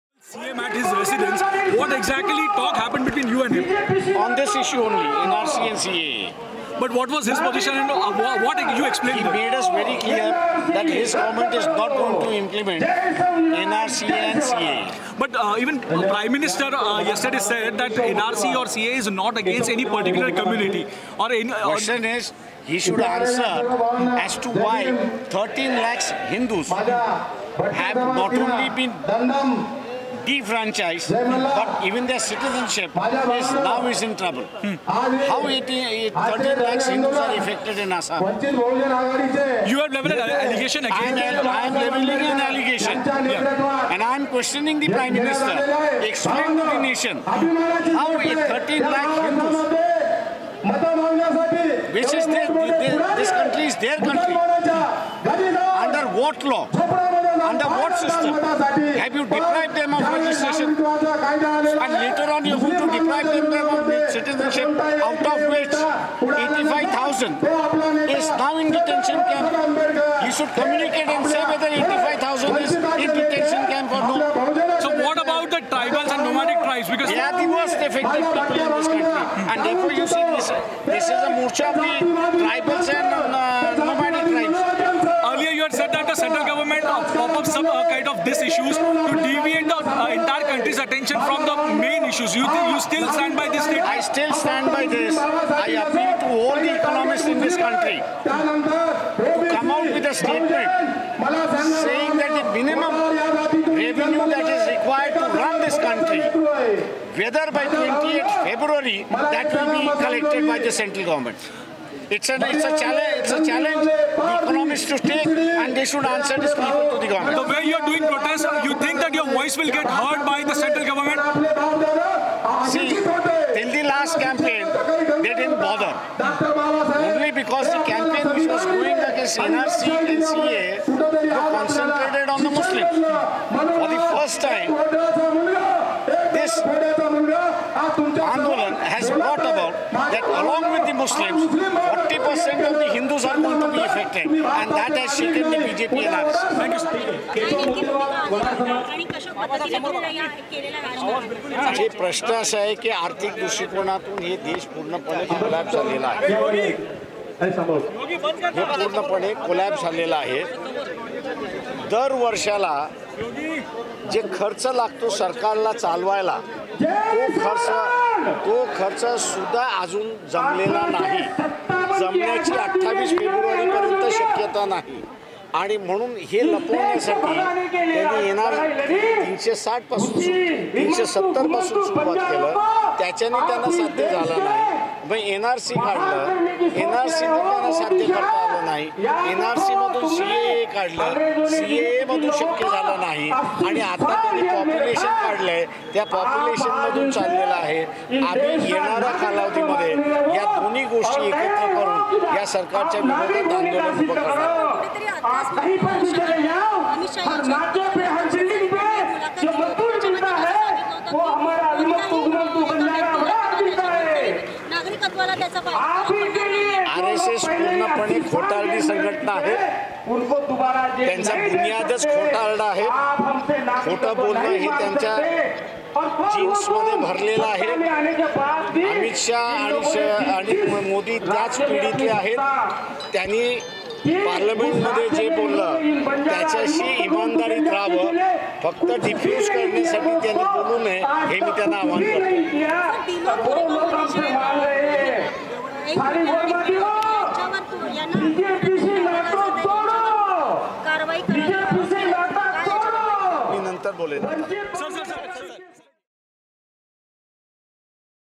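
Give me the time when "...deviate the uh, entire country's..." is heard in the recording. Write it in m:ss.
1:29.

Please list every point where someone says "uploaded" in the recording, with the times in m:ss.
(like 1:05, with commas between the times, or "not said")
not said.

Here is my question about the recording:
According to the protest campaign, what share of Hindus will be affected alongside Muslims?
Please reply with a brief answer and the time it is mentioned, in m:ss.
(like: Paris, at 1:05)
40%, at 2:21.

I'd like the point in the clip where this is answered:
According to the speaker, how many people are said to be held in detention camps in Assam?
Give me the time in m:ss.
1:06.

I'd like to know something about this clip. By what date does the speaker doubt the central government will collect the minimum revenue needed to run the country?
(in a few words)
28th February.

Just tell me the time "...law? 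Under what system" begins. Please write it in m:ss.
0:56.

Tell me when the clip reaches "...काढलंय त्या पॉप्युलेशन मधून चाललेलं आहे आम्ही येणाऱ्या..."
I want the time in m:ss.
3:15.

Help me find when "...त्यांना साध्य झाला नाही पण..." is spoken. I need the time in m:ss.
3:03.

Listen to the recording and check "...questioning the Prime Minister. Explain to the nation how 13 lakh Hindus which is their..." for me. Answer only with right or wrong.
right.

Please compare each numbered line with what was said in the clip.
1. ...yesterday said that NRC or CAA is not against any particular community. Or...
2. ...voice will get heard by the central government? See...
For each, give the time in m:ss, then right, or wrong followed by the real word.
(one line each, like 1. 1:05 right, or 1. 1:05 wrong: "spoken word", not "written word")
1. 0:17 right
2. 1:59 right.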